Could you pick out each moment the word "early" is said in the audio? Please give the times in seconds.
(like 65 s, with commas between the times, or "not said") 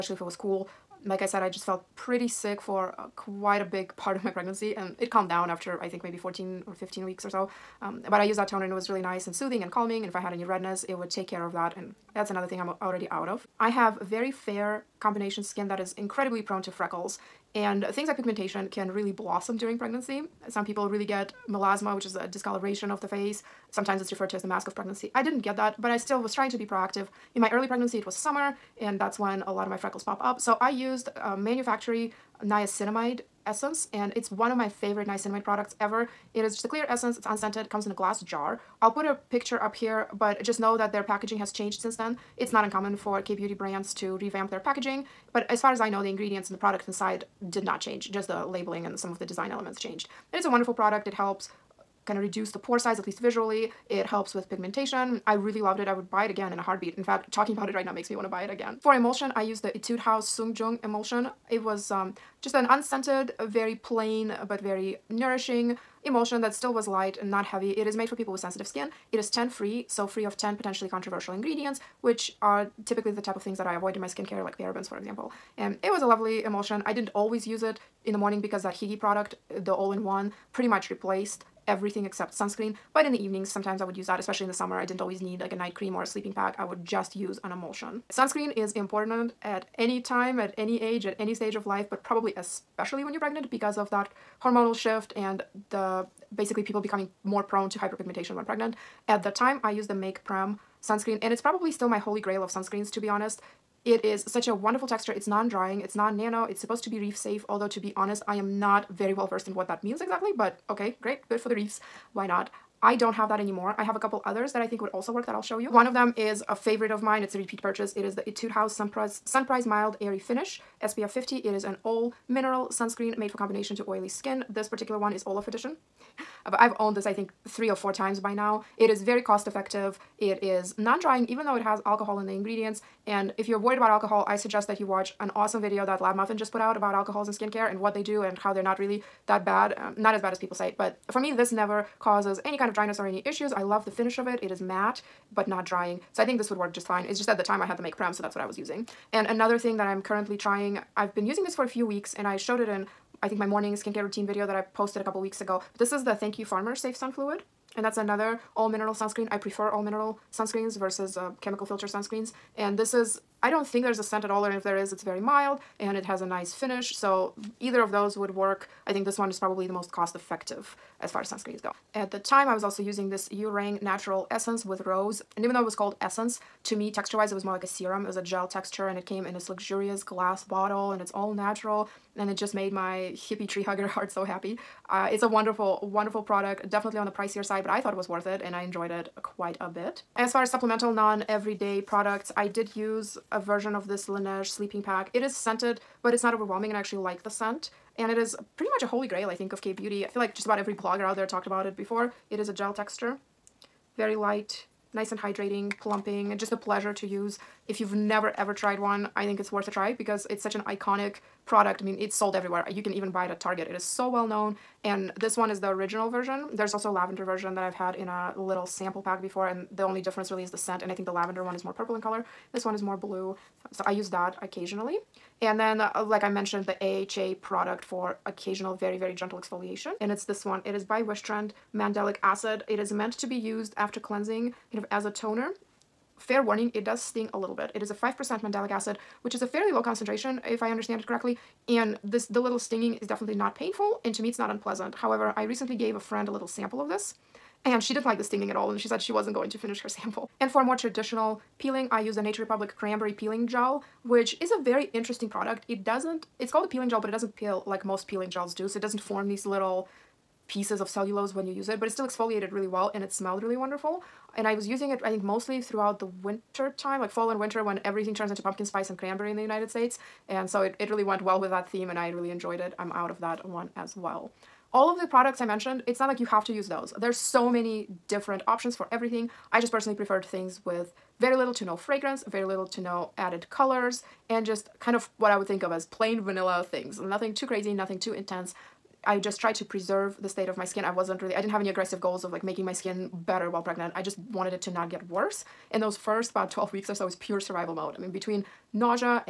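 27 s.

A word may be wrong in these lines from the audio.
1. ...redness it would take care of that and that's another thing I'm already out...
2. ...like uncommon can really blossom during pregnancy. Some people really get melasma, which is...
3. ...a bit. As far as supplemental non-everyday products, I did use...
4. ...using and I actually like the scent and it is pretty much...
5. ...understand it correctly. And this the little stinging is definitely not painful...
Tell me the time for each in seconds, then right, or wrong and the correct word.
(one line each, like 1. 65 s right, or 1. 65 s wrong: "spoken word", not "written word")
1. 10 s right
2. 18 s wrong: "pigmentation", not "uncommon"
3. 189 s right
4. 196 s wrong: "overwhelming", not "using"
5. 240 s right.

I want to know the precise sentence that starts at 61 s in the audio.
It was um, just an unscented, very plain, but very nourishing emulsion that still was light and not heavy.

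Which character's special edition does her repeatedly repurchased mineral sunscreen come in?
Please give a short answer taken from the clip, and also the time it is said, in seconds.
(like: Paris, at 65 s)
Olaf, at 125 s.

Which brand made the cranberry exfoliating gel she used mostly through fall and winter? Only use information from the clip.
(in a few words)
Nature Republic.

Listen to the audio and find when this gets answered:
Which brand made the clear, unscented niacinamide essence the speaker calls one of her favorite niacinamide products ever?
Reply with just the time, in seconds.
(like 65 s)
31 s.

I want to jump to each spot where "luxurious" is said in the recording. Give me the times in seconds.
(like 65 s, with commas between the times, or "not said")
179 s.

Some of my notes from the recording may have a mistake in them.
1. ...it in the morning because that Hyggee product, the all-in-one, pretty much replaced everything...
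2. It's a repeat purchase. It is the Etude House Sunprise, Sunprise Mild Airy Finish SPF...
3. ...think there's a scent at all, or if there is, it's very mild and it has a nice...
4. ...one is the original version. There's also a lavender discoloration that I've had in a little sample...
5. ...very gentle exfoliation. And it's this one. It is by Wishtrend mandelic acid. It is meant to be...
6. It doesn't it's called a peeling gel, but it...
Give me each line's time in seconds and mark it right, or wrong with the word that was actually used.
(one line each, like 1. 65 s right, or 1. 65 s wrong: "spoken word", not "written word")
1. 77 s right
2. 117 s right
3. 163 s right
4. 215 s wrong: "version", not "discoloration"
5. 228 s right
6. 255 s right.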